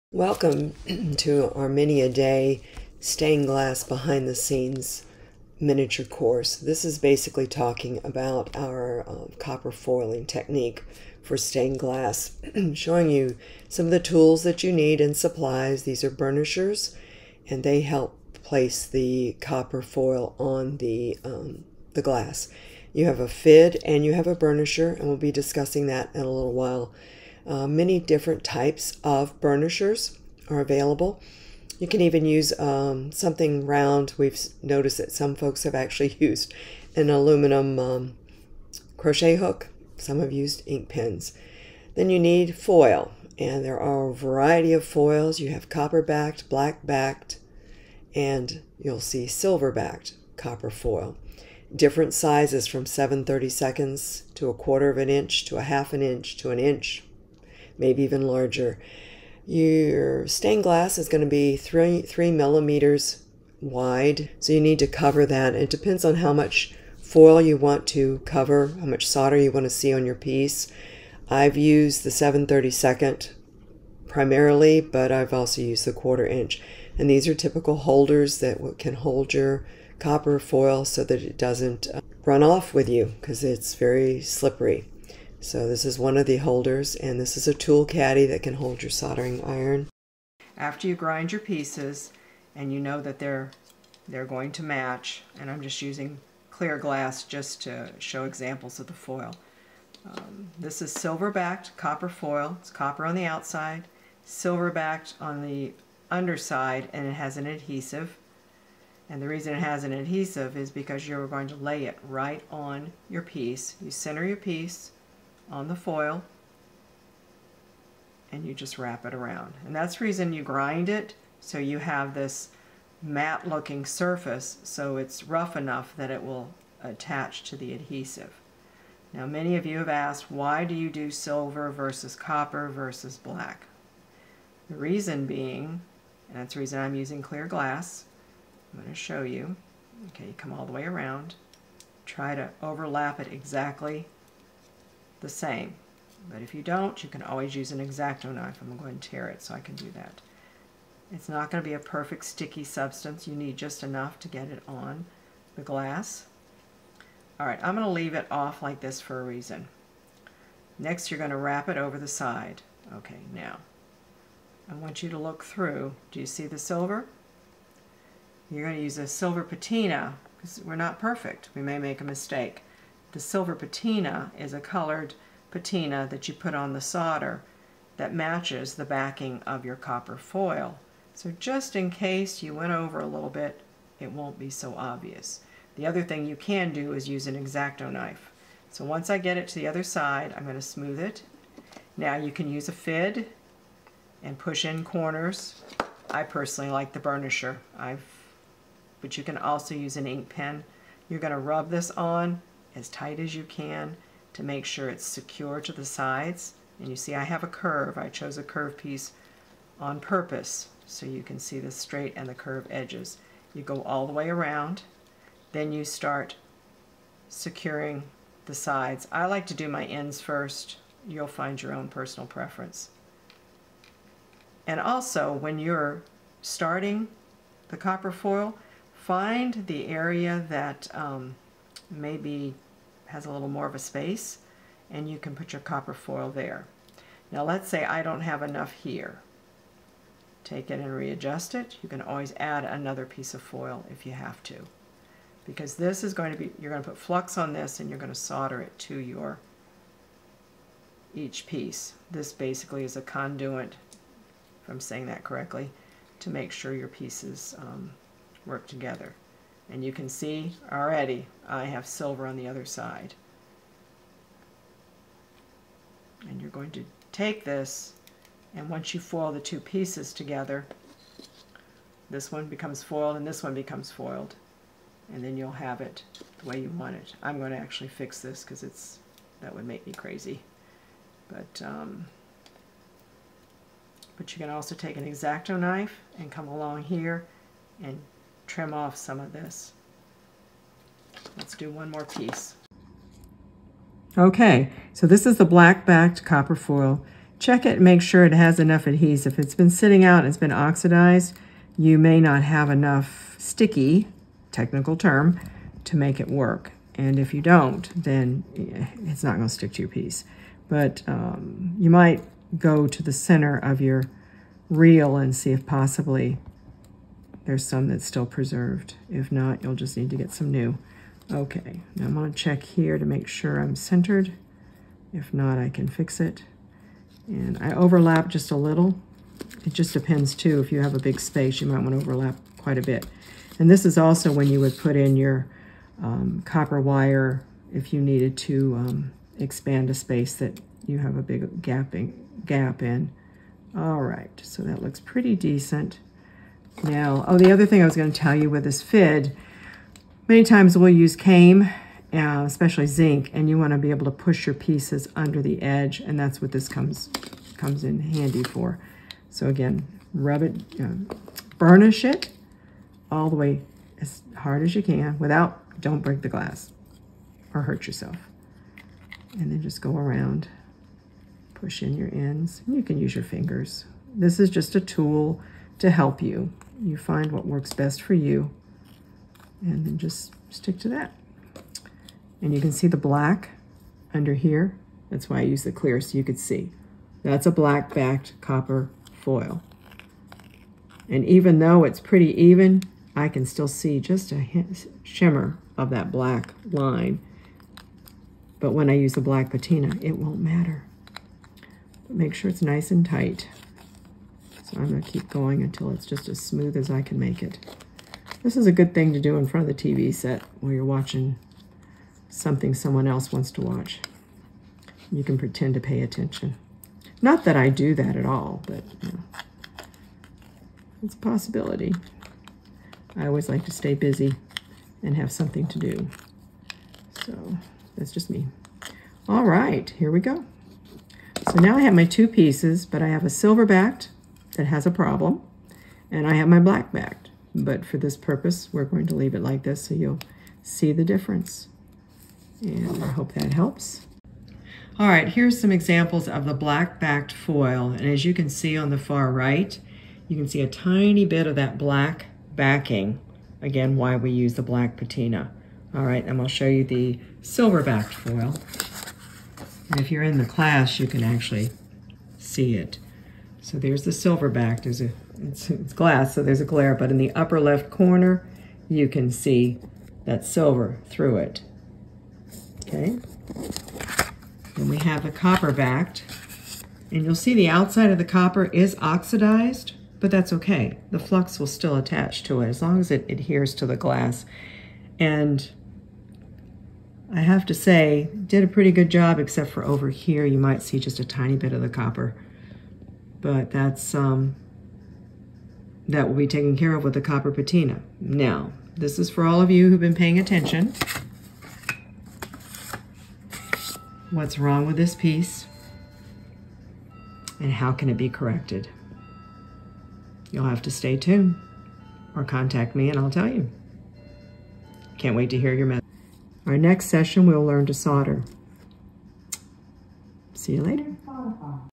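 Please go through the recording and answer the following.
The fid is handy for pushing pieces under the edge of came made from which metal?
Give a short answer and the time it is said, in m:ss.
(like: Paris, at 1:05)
zinc, at 5:52.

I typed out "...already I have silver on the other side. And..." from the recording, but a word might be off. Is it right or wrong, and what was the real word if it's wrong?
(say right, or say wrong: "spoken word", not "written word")
right.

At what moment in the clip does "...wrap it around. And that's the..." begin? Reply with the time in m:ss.
1:58.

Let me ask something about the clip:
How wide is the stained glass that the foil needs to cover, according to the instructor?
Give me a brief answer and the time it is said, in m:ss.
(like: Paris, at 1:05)
3 millimeters, at 1:02.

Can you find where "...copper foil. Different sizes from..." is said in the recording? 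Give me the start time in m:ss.
0:50.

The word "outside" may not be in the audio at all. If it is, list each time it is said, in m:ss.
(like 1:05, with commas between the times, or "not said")
1:43, 7:57.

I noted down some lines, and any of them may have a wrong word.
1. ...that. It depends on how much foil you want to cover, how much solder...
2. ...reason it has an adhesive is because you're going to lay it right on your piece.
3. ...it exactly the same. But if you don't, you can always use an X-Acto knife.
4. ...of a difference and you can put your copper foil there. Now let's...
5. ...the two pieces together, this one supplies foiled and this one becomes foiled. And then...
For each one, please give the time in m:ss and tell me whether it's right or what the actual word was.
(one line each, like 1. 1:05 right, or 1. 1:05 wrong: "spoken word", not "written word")
1. 1:05 right
2. 1:49 right
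3. 2:23 right
4. 3:53 wrong: "space", not "difference"
5. 4:29 wrong: "becomes", not "supplies".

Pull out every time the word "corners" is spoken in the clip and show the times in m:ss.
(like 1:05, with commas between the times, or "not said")
3:14, 7:47.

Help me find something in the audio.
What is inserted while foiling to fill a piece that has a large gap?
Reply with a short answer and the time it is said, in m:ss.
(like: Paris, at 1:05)
copper wire, at 5:36.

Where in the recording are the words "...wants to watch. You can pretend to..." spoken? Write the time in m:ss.
6:53.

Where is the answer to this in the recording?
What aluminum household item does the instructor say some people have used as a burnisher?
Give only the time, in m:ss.
0:37.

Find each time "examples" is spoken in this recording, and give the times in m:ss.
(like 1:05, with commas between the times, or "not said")
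1:38, 7:25.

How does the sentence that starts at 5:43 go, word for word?
All right, so that looks pretty decent.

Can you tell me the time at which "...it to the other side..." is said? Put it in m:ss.
3:09.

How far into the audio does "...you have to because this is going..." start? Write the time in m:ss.
4:04.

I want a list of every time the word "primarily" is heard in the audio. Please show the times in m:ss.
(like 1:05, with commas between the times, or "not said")
1:14.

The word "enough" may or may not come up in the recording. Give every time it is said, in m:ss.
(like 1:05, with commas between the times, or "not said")
2:05, 2:33, 3:58, 4:58, 5:02.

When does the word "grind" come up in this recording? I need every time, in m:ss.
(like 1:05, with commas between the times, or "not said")
1:30, 2:00.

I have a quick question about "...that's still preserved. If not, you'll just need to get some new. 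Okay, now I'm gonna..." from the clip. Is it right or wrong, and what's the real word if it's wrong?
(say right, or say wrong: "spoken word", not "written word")
right.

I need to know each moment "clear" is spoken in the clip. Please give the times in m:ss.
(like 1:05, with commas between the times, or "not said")
1:36, 2:17, 6:25.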